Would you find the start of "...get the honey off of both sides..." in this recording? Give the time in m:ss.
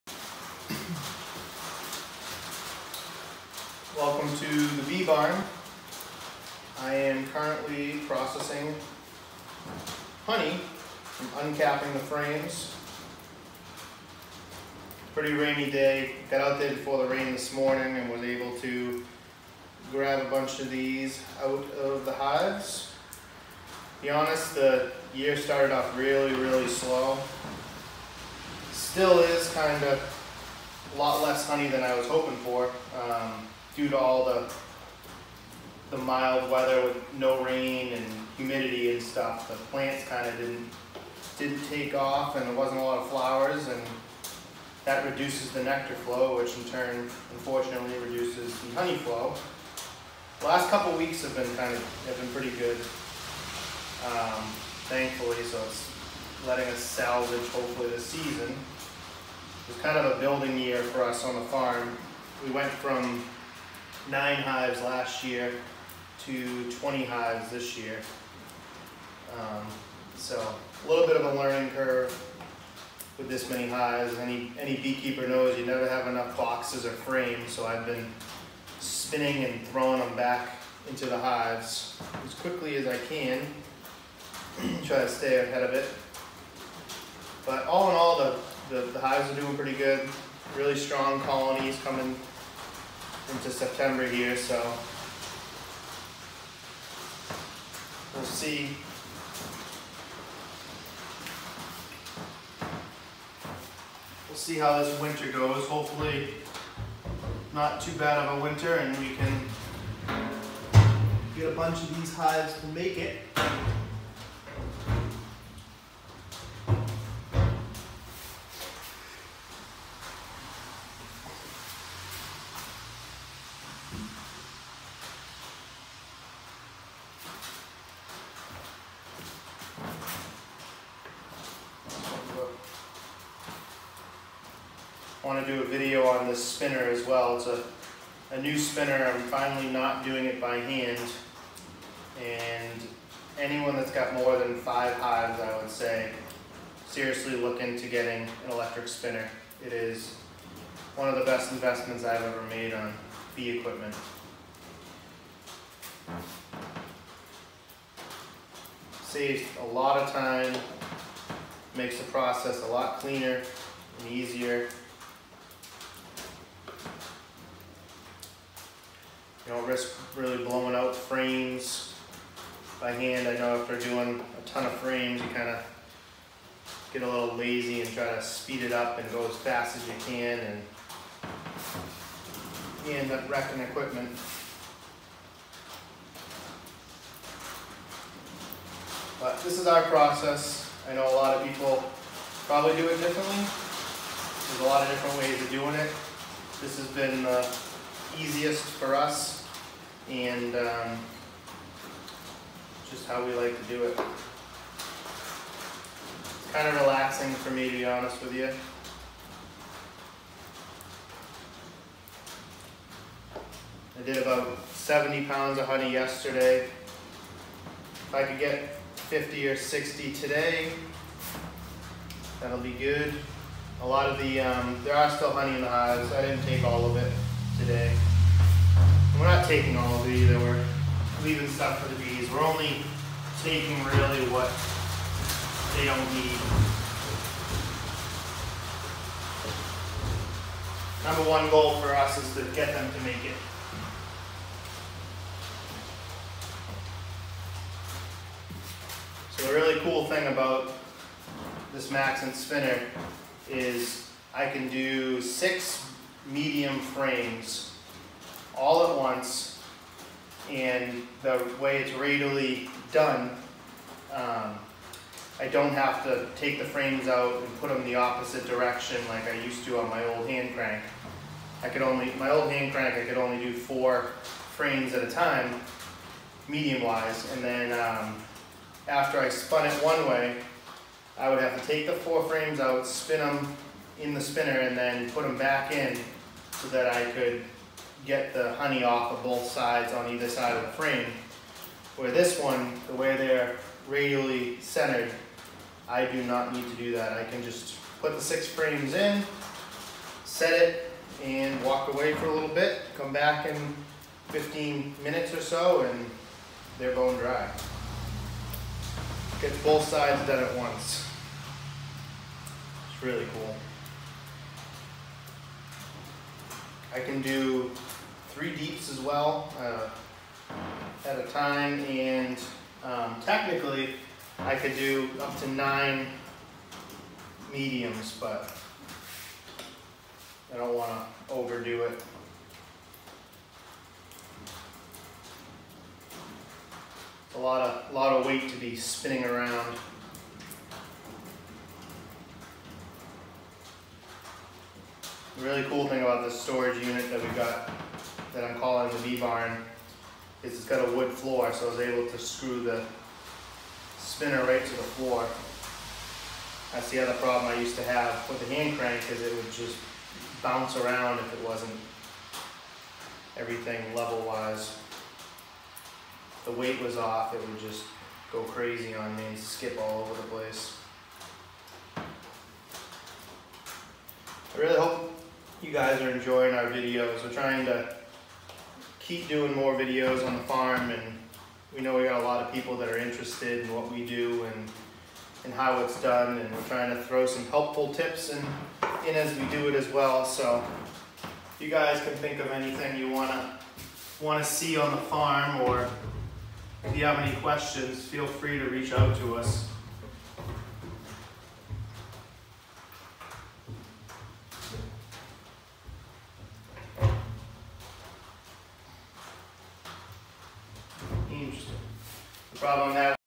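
4:48.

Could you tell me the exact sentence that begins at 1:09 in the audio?
Um, so a little bit of a learning curve with this many hives.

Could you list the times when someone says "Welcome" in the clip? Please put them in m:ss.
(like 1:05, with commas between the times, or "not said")
0:04.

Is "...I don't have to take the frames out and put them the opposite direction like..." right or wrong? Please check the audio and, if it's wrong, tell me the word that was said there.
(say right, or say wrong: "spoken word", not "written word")
right.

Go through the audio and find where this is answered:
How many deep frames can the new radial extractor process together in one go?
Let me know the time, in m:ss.
5:18.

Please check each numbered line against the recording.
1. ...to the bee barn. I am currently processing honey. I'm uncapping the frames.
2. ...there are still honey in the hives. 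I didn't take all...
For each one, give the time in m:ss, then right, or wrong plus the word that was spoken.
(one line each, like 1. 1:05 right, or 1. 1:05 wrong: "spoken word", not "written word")
1. 0:04 right
2. 3:44 right.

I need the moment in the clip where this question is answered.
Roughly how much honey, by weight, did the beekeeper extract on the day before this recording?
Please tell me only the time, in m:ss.
3:34.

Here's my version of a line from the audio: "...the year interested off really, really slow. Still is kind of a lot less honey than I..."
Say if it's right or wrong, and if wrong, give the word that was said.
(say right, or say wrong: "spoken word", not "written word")
wrong: "started", not "interested".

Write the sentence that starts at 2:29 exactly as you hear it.
It is one of the best investments I've ever made on bee equipment.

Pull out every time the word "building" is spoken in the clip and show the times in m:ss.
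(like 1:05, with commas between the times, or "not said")
1:00.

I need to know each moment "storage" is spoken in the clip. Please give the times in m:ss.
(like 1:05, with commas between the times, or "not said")
5:46.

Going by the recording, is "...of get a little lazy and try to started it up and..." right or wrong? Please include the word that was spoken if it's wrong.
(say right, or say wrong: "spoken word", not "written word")
wrong: "speed", not "started".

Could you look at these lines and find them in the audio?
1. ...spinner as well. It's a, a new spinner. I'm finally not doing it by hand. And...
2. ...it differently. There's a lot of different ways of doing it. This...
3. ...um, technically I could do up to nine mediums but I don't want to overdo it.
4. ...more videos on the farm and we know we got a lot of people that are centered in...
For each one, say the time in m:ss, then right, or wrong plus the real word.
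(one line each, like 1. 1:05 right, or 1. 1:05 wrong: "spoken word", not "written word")
1. 2:16 right
2. 3:12 right
3. 5:22 right
4. 6:19 wrong: "interested", not "centered".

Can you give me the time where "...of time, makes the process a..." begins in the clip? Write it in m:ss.
2:39.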